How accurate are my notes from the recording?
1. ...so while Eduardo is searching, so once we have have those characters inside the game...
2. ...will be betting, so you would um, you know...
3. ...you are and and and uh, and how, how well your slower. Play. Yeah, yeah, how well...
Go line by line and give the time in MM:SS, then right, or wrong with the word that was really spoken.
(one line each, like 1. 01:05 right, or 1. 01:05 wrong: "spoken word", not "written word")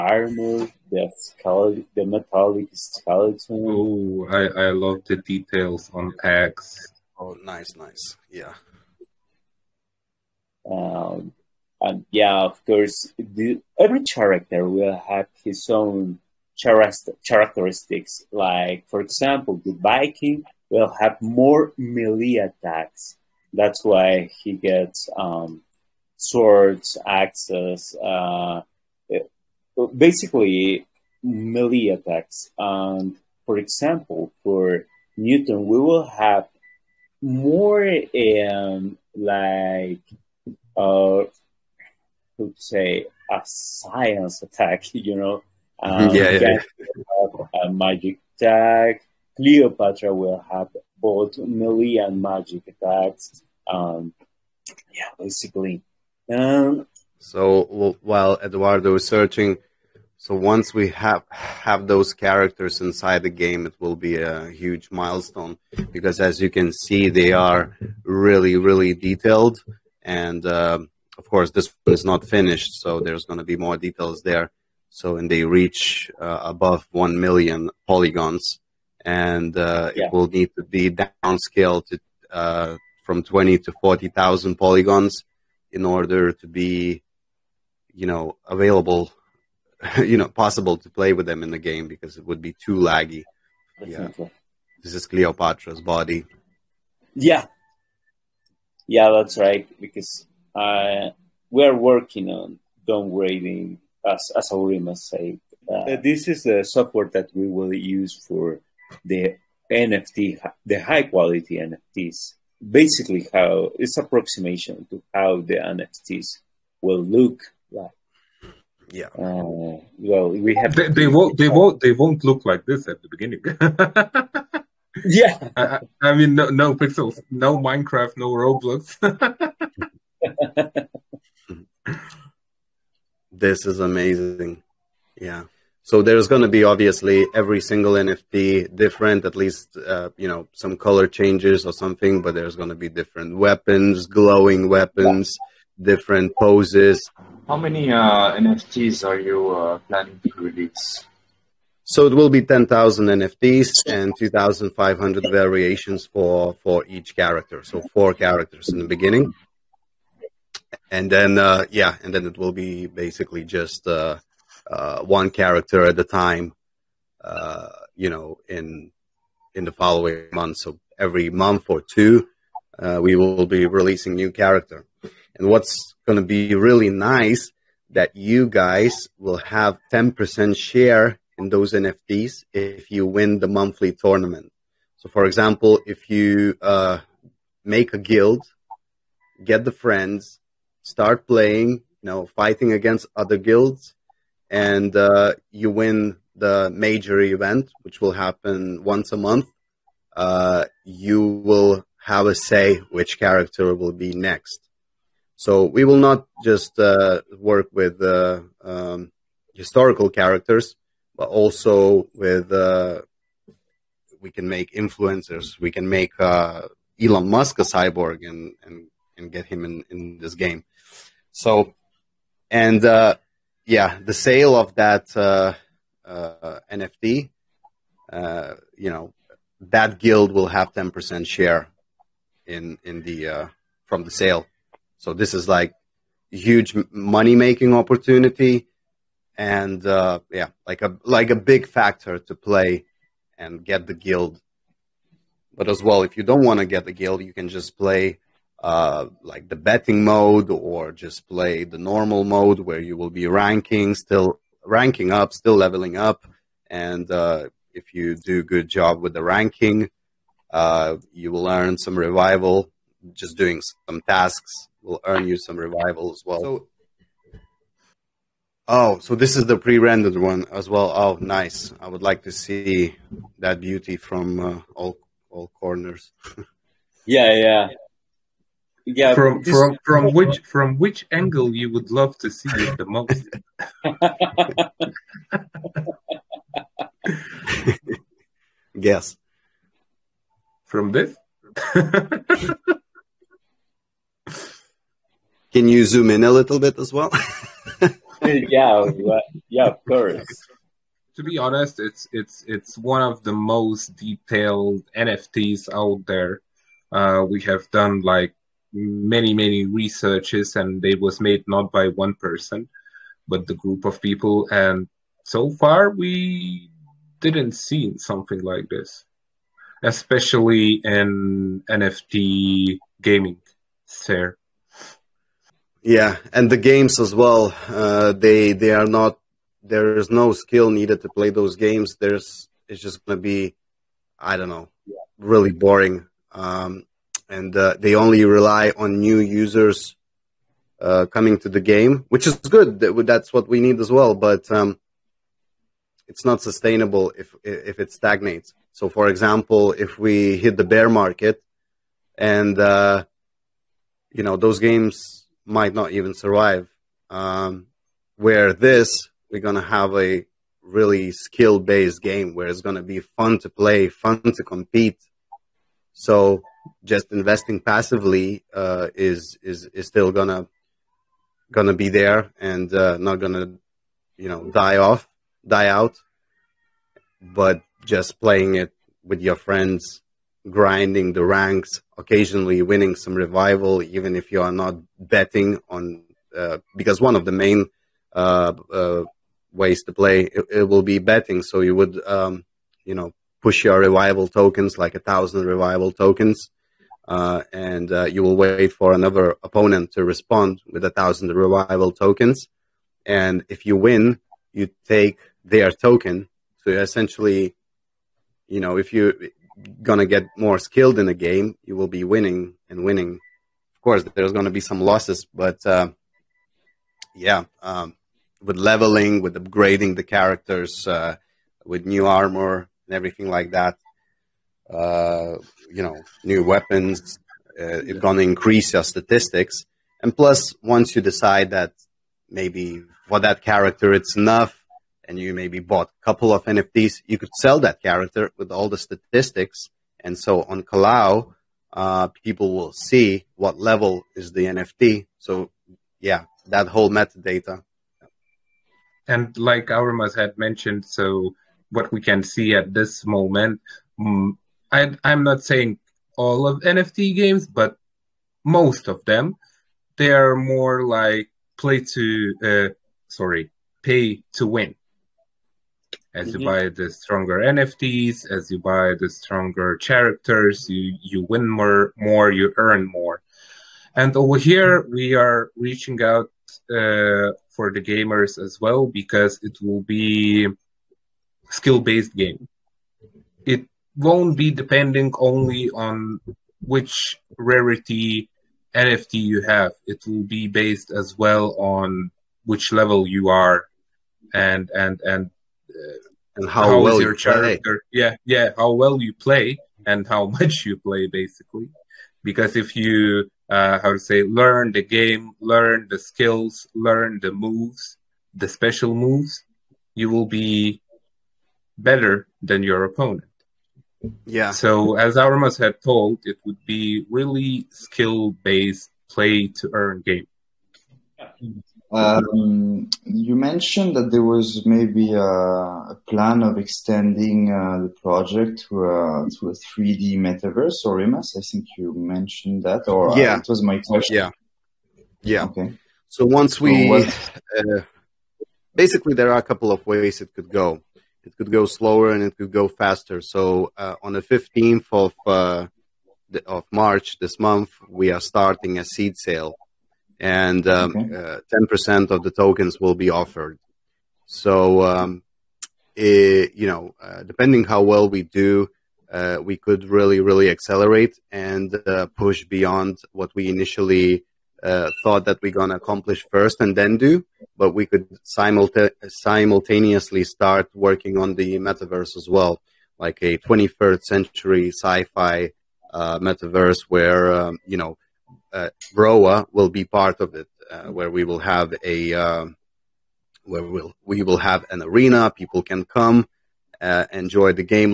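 1. 00:57 right
2. 06:30 right
3. 08:13 wrong: "character", not "slower".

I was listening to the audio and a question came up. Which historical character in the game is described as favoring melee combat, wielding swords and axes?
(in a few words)
The Viking.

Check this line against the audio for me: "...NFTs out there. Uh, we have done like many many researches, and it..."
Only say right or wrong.
right.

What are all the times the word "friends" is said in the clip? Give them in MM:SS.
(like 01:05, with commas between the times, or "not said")
03:09, 06:19.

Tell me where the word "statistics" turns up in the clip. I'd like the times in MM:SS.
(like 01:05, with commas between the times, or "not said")
07:08, 07:18.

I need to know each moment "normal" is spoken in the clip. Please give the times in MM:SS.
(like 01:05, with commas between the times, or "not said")
04:11.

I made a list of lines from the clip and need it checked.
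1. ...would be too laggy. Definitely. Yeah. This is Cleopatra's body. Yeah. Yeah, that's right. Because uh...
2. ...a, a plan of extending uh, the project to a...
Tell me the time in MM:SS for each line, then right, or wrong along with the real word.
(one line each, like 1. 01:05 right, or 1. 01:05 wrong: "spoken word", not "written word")
1. 01:32 right
2. 08:45 right.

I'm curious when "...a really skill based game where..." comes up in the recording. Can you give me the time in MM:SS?
05:59.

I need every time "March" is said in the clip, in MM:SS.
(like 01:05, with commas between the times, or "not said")
09:06.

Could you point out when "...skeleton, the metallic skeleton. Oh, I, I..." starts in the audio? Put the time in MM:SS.
00:01.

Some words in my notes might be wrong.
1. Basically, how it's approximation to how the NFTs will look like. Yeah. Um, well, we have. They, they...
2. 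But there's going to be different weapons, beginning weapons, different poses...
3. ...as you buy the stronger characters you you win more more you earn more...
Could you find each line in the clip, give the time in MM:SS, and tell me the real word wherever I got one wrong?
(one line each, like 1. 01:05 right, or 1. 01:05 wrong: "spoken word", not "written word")
1. 01:52 right
2. 02:22 wrong: "glowing", not "beginning"
3. 07:48 right.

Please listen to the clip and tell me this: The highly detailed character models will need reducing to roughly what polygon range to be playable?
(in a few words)
20,000 to 40,000.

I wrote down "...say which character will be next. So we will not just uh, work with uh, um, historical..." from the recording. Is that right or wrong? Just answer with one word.
right.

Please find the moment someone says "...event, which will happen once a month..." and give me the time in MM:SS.
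03:17.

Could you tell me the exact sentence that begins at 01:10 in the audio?
And uh, of course, this one is not finished, so there's going to be more details there.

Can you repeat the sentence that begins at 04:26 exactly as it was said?
So, oh, so this is the pre-rendered one as well.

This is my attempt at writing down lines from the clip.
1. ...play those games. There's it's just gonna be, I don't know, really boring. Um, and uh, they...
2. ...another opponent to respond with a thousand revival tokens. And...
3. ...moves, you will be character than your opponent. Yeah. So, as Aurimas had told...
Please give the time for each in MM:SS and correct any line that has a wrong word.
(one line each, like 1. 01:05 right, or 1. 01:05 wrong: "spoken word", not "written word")
1. 05:31 right
2. 06:38 right
3. 08:28 wrong: "better", not "character".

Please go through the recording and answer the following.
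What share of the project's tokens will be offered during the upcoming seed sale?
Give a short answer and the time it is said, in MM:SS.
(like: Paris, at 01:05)
10%, at 09:11.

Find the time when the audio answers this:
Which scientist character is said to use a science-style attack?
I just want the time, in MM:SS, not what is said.
00:35.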